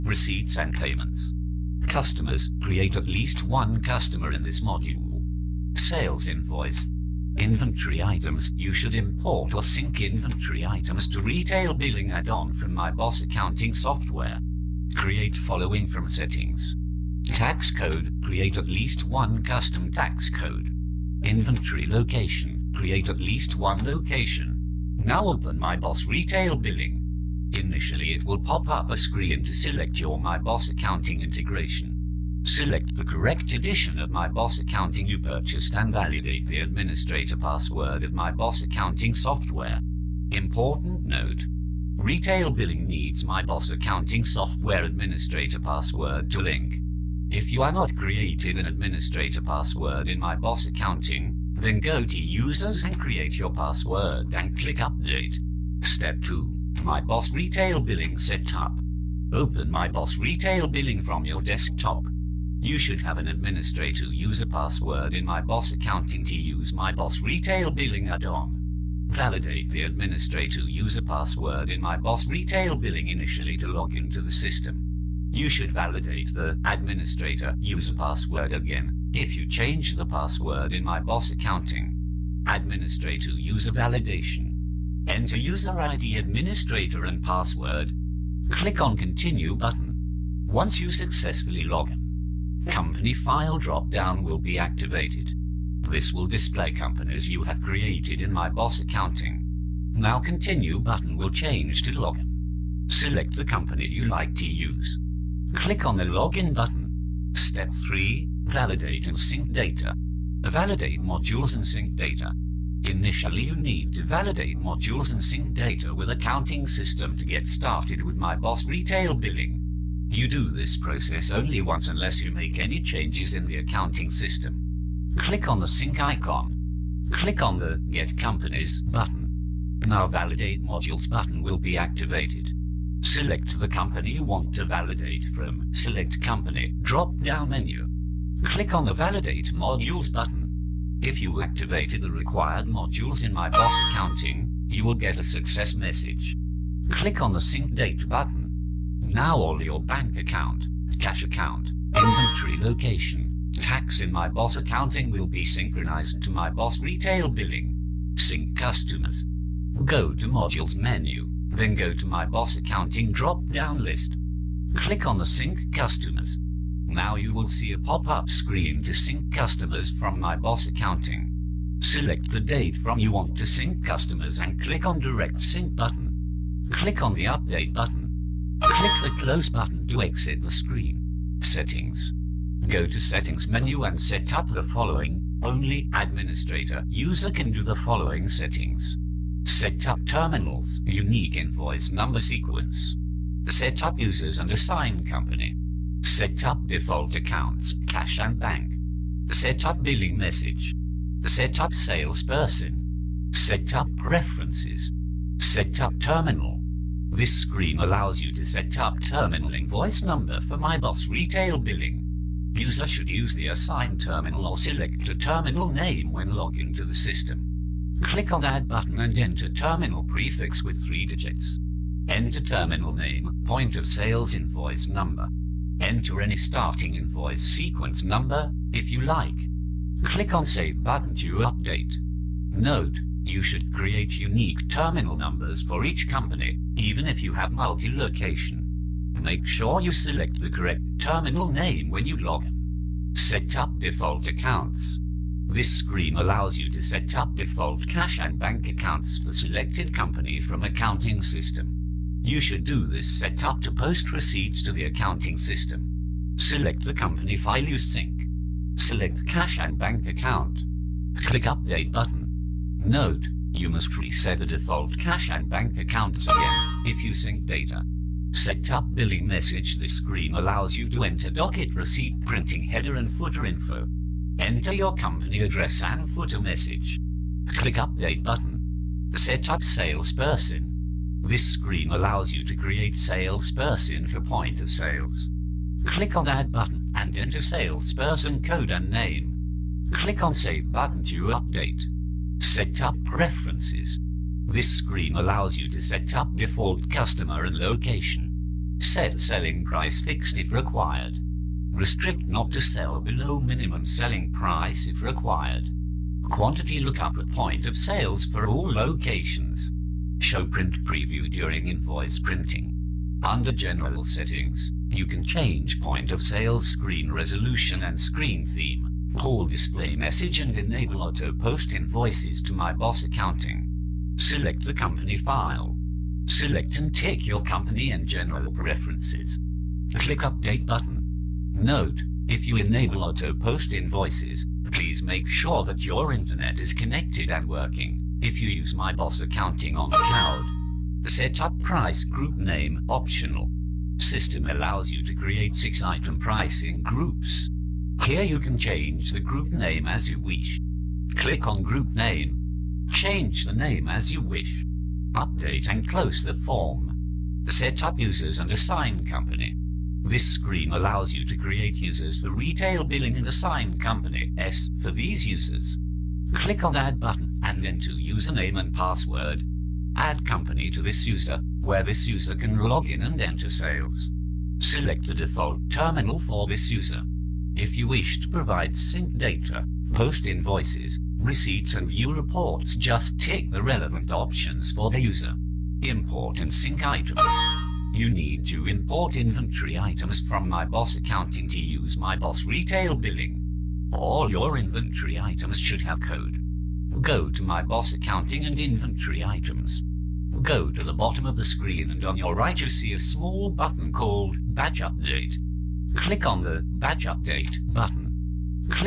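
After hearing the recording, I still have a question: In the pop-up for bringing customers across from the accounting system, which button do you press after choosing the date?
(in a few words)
Direct Sync.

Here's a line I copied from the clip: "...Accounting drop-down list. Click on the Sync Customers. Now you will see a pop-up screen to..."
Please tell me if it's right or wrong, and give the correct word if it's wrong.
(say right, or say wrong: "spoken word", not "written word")
right.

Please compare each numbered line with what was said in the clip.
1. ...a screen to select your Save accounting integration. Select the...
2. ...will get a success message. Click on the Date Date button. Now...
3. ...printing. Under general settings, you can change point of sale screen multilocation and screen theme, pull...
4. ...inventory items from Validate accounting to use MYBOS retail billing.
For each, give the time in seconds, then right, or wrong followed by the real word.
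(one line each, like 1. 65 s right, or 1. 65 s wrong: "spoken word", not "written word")
1. 28 s wrong: "MYBOS", not "Save"
2. 144 s wrong: "Sync", not "Date"
3. 312 s wrong: "resolution", not "multilocation"
4. 389 s wrong: "MYBOS", not "Validate".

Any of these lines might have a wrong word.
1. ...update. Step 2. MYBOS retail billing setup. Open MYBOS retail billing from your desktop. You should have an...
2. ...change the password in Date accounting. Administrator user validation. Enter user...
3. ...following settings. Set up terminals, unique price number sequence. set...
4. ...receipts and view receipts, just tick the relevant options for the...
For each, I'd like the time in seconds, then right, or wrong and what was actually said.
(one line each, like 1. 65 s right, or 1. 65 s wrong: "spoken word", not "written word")
1. 54 s right
2. 79 s wrong: "MYBOS", not "Date"
3. 187 s wrong: "invoice", not "price"
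4. 381 s wrong: "reports", not "receipts".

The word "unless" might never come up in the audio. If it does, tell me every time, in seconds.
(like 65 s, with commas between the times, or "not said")
121 s.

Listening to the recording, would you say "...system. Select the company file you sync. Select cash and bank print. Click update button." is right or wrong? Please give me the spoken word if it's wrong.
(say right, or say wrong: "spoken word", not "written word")
wrong: "account", not "print".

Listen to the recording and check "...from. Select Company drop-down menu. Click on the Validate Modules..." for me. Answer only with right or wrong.
right.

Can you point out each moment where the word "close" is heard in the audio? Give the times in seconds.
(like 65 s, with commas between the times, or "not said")
179 s, 355 s.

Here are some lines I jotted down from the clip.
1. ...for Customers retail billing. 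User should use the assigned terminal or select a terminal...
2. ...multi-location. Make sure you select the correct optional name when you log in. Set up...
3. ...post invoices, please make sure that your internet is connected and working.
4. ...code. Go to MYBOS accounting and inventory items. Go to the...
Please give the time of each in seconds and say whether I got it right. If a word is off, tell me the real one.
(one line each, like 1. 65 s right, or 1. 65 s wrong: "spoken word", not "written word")
1. 210 s wrong: "MYBOS", not "Customers"
2. 237 s wrong: "terminal", not "optional"
3. 333 s right
4. 395 s right.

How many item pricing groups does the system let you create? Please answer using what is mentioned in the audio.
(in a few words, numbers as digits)
6.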